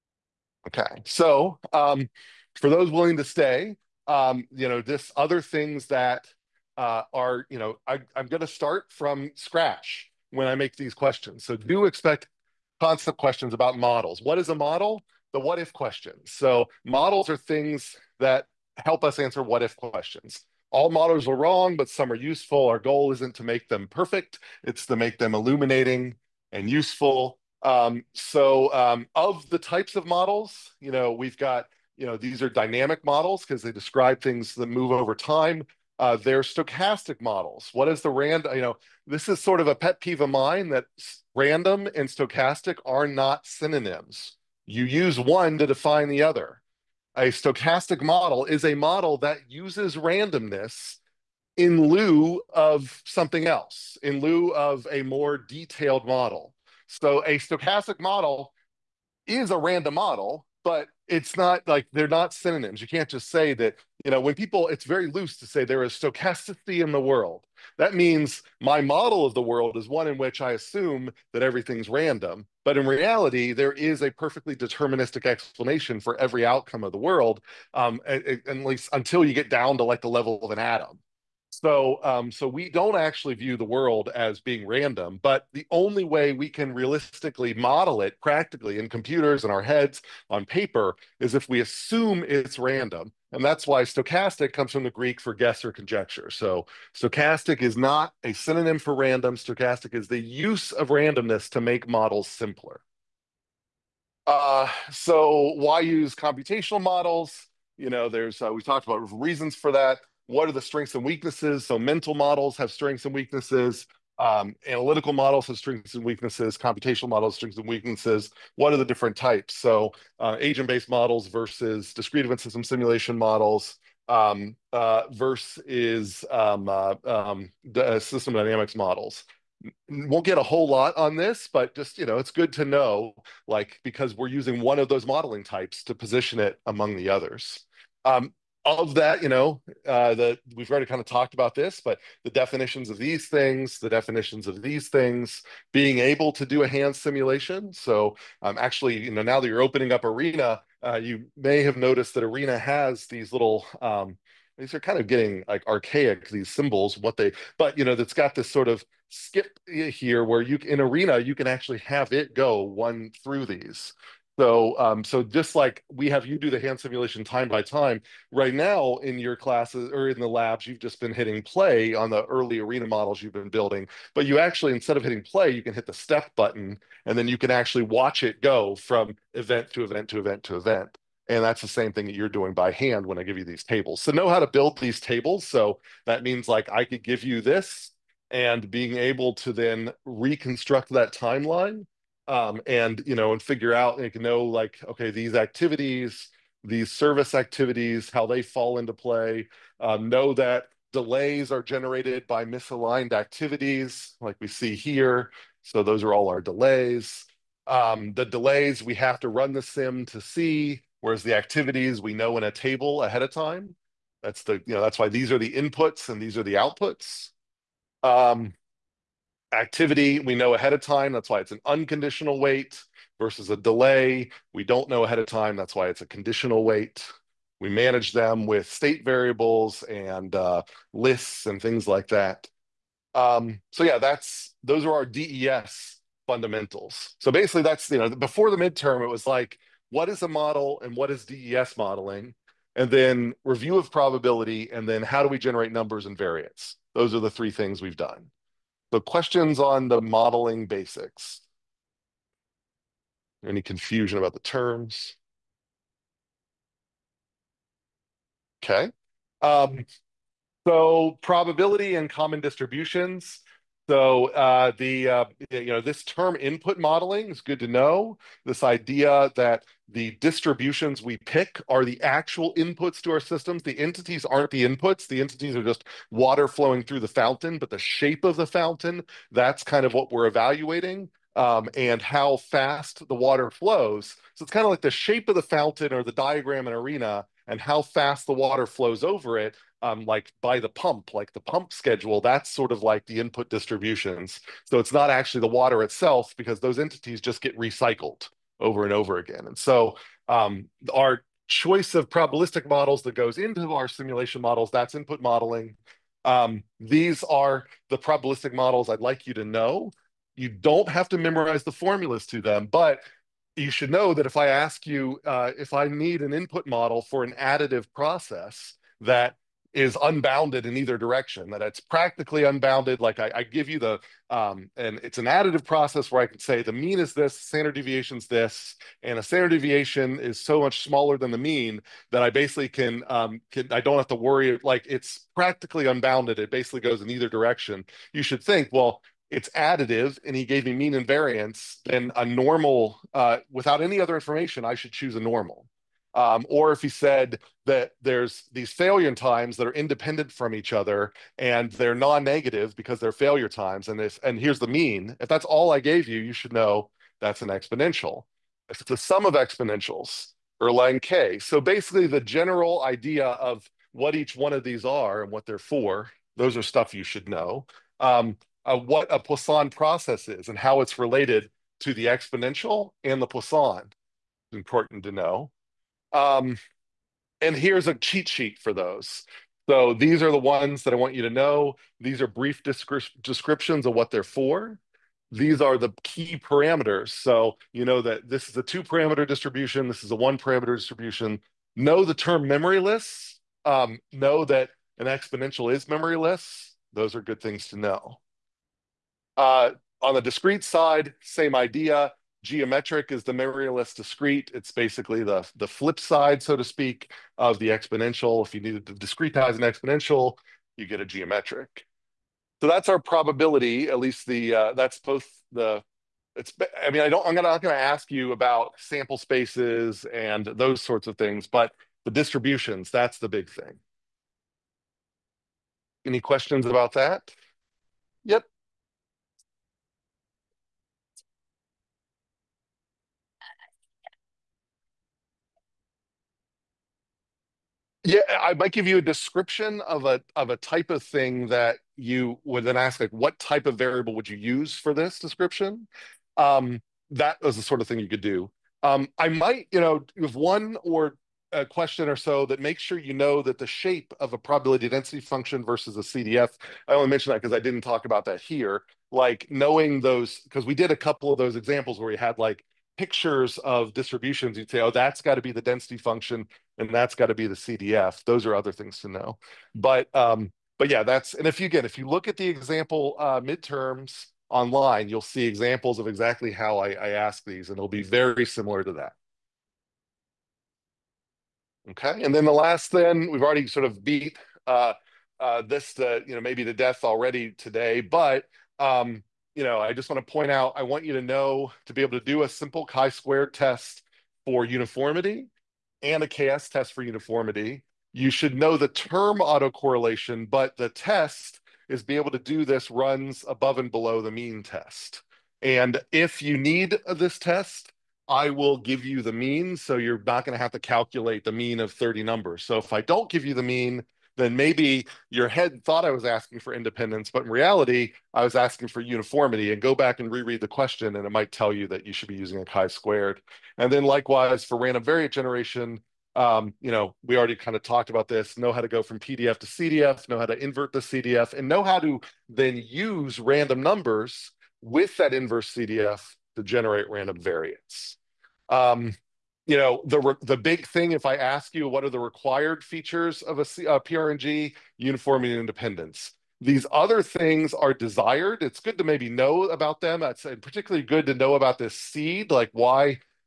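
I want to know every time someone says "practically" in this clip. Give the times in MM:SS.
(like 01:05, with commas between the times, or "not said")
01:28, 05:21, 05:35.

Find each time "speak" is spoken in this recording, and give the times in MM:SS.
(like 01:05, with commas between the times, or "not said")
06:46.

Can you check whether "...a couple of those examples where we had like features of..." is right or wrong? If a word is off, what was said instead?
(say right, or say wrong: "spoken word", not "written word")
wrong: "pictures", not "features".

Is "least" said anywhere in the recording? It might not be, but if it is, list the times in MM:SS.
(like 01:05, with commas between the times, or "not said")
01:18, 06:53.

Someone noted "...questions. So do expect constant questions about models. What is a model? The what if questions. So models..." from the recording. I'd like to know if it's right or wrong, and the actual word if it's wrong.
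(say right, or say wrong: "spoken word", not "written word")
right.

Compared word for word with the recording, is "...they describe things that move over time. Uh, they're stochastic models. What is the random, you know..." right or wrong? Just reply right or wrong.
right.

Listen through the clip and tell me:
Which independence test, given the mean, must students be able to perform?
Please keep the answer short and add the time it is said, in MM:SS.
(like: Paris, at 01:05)
runs above and below the mean, at 08:22.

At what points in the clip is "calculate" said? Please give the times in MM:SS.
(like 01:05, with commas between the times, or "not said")
08:30.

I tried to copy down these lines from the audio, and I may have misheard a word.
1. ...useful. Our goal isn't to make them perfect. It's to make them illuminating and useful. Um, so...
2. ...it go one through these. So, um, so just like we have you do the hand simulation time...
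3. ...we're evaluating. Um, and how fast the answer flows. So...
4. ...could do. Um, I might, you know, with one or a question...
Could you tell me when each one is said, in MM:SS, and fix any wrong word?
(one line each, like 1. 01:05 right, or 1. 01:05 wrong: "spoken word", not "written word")
1. 00:22 right
2. 02:42 right
3. 04:40 wrong: "water", not "answer"
4. 07:28 right.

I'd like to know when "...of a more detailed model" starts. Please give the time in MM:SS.
00:54.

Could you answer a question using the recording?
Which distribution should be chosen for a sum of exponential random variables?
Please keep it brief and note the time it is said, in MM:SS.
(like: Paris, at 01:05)
Erlang K, at 06:00.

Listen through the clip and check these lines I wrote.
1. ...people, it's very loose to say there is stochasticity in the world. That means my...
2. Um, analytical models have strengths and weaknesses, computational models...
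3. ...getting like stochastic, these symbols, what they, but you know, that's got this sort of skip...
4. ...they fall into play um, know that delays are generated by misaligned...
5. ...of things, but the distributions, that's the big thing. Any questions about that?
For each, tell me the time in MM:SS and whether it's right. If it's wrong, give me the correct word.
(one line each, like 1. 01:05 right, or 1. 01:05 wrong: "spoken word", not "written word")
1. 01:04 right
2. 01:54 right
3. 02:35 wrong: "archaic", not "stochastic"
4. 03:18 right
5. 07:01 right.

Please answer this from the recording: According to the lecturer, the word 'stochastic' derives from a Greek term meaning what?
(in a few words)
guess or conjecture.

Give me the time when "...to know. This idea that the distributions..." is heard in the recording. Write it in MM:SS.
04:27.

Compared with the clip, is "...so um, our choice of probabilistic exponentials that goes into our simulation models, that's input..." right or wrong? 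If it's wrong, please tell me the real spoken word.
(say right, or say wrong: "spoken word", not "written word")
wrong: "models", not "exponentials".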